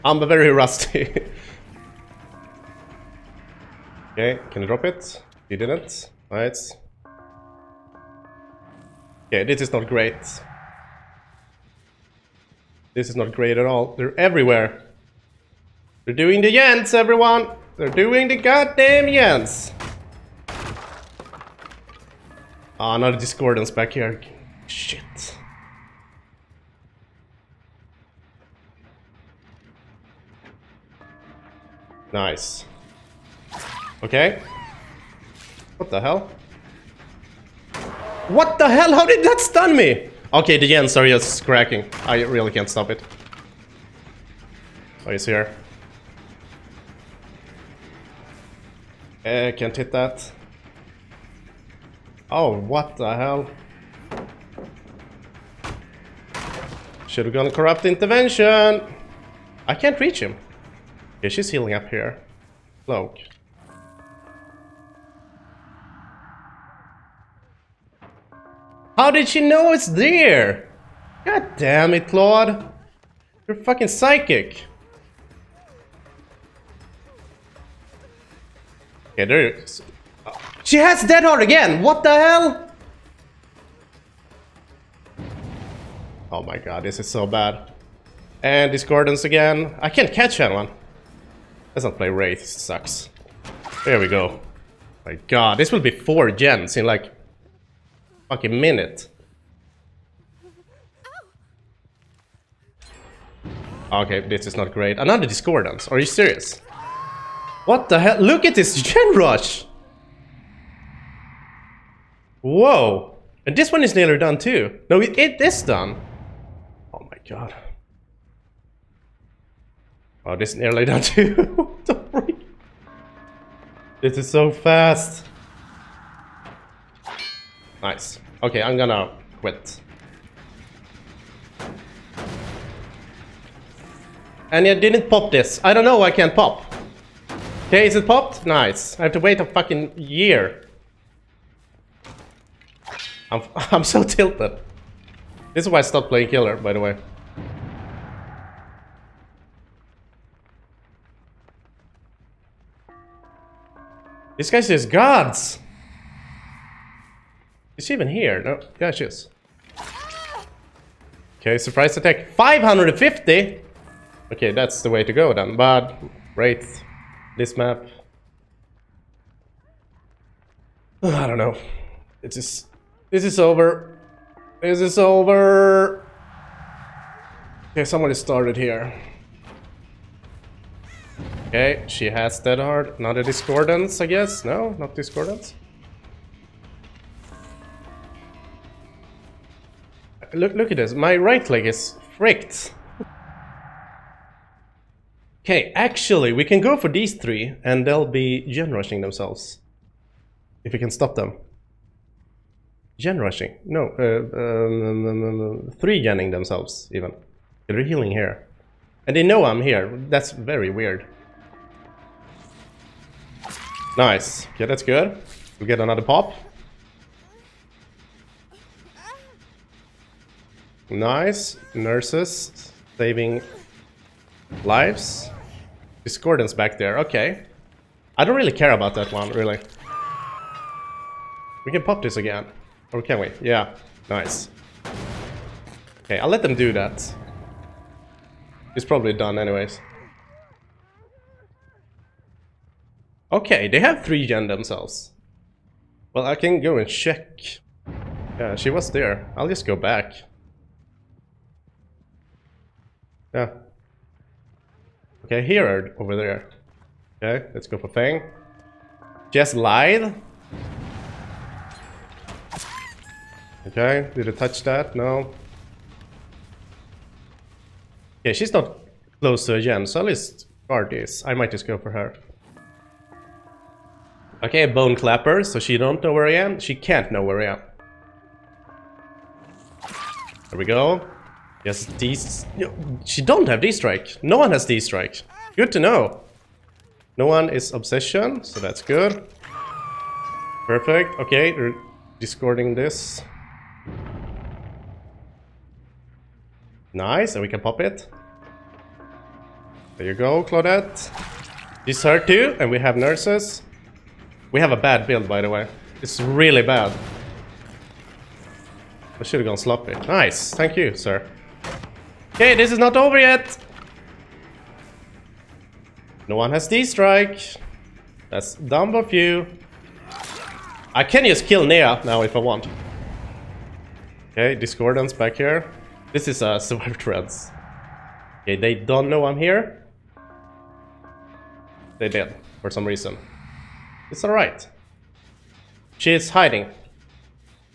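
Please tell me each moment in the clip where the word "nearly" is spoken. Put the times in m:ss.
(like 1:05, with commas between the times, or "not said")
1:53, 2:00.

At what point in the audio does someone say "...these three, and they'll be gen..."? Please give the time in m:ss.
3:16.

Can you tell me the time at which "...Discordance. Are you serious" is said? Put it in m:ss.
1:45.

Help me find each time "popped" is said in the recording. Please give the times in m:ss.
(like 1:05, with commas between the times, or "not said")
2:18.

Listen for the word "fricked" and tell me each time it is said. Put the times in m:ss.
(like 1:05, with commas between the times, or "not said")
3:12.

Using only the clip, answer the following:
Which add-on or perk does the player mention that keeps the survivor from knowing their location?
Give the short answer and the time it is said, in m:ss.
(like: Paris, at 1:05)
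Bone Clapper, at 4:34.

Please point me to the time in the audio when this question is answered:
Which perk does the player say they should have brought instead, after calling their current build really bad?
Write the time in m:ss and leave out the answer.
5:09.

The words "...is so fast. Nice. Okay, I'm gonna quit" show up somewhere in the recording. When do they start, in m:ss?
2:04.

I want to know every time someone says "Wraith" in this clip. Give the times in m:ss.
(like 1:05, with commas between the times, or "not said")
1:32.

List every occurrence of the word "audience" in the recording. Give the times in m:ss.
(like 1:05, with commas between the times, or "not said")
not said.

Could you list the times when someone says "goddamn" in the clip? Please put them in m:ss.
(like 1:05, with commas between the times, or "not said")
0:18.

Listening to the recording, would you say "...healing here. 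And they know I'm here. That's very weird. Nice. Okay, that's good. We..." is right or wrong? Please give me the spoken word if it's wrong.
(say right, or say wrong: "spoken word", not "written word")
right.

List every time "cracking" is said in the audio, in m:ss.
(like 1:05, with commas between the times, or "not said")
0:41.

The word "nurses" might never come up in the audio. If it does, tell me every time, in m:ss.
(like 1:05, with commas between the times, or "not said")
3:41, 5:02.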